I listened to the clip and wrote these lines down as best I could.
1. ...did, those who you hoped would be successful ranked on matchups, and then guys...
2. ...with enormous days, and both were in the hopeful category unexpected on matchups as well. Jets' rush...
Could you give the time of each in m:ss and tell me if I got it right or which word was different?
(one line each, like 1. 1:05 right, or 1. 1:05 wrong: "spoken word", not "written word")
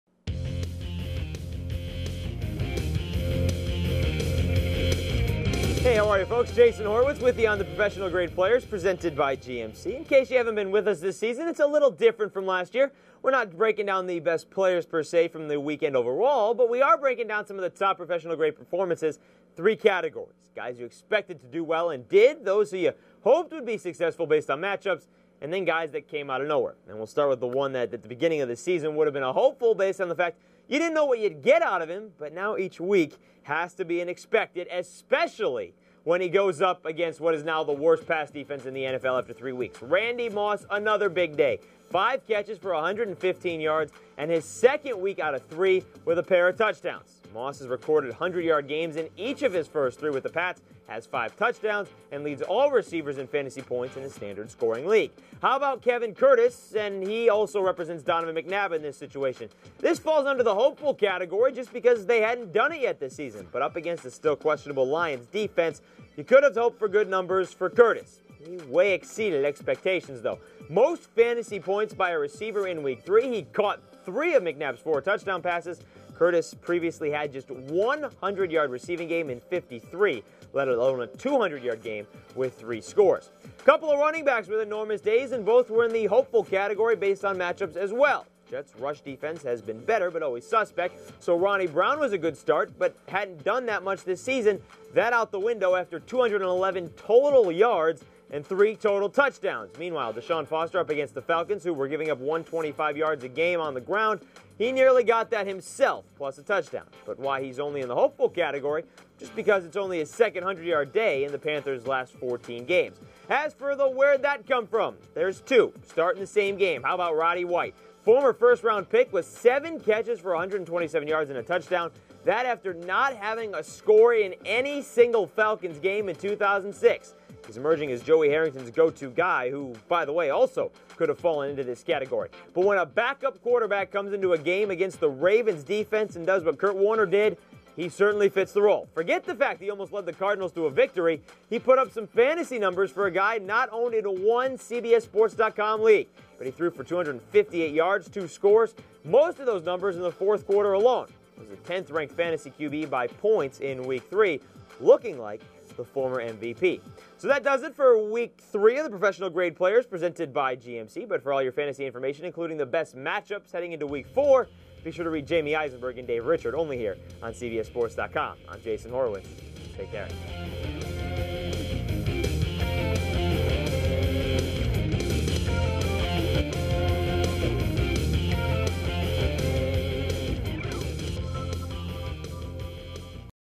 1. 0:22 wrong: "based", not "ranked"
2. 1:24 wrong: "based", not "unexpected".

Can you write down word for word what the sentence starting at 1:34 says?
That out the window after 211 total yards and three total touchdowns.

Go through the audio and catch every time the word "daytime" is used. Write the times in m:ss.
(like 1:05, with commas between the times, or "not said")
not said.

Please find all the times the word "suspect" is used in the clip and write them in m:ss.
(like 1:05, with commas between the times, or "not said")
1:30.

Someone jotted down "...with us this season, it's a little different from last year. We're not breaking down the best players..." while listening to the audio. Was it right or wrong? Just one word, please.
right.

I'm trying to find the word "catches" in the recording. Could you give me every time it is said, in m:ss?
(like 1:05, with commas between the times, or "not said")
0:42, 1:59.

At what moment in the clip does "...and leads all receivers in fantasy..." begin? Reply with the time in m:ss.
0:52.